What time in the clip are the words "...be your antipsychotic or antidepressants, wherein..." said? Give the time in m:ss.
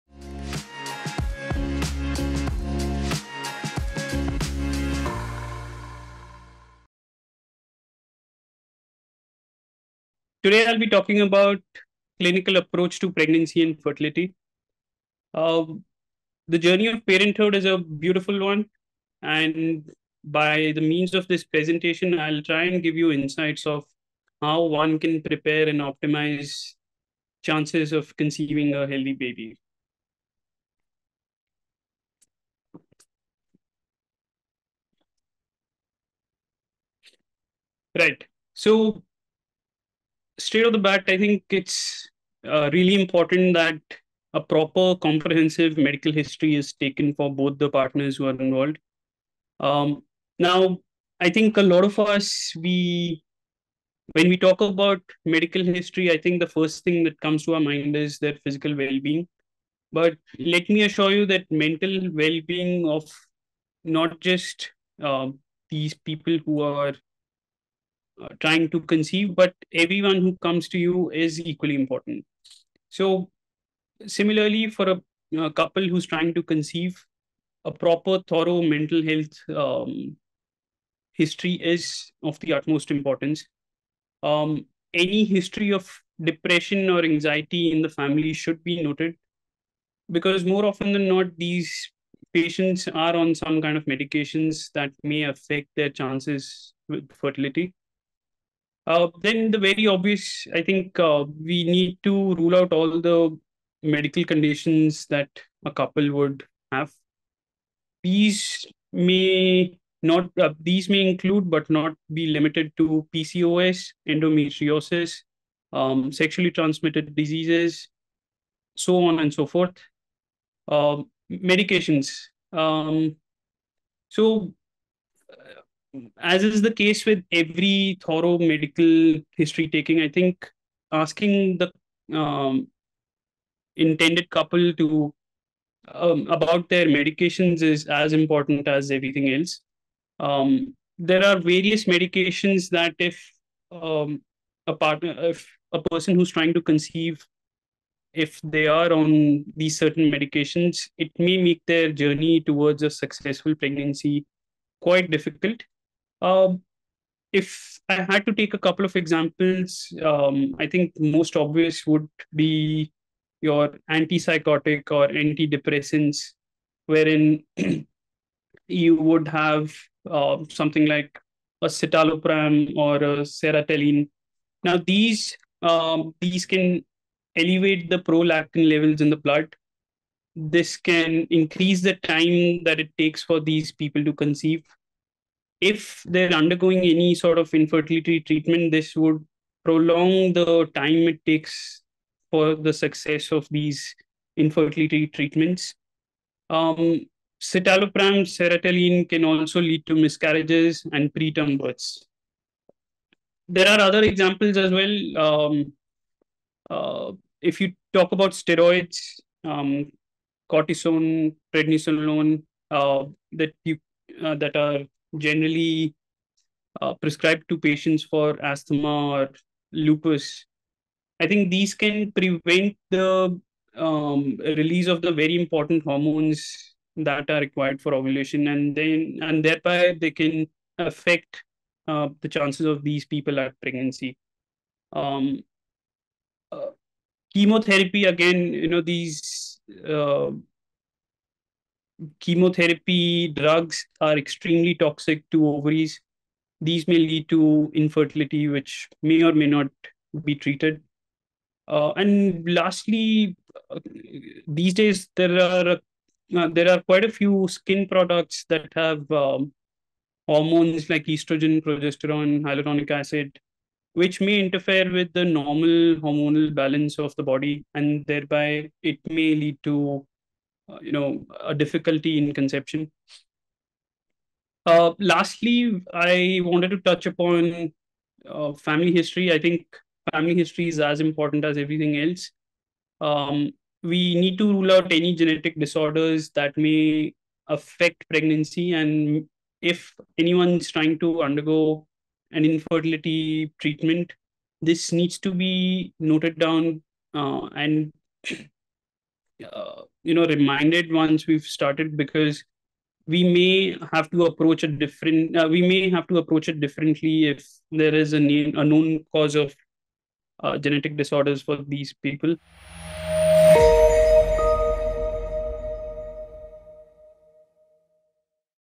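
2:42.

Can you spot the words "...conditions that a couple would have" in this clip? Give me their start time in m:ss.
1:44.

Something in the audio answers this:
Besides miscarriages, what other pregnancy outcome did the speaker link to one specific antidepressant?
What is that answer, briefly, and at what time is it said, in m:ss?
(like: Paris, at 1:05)
preterm births, at 3:21.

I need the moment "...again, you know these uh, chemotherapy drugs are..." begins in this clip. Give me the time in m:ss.
3:58.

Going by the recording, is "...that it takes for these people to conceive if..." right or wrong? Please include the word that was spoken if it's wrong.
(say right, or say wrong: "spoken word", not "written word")
right.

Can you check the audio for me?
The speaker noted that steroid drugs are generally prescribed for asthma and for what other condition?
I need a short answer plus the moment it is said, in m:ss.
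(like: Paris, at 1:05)
lupus, at 3:39.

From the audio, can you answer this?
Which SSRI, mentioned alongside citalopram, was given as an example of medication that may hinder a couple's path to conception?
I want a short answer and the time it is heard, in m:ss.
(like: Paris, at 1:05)
sertraline, at 2:53.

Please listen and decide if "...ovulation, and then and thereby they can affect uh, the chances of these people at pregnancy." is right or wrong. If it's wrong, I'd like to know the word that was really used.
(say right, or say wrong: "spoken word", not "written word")
right.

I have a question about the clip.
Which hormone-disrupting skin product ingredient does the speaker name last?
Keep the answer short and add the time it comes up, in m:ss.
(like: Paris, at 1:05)
hyaluronic acid, at 4:22.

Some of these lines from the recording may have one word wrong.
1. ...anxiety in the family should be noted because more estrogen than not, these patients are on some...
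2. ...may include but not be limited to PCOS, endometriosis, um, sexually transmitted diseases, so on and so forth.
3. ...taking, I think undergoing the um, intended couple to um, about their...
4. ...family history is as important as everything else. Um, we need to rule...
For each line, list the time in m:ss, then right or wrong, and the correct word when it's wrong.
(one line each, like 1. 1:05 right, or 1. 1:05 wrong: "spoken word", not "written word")
1. 1:27 wrong: "often", not "estrogen"
2. 1:50 right
3. 2:09 wrong: "asking", not "undergoing"
4. 4:40 right.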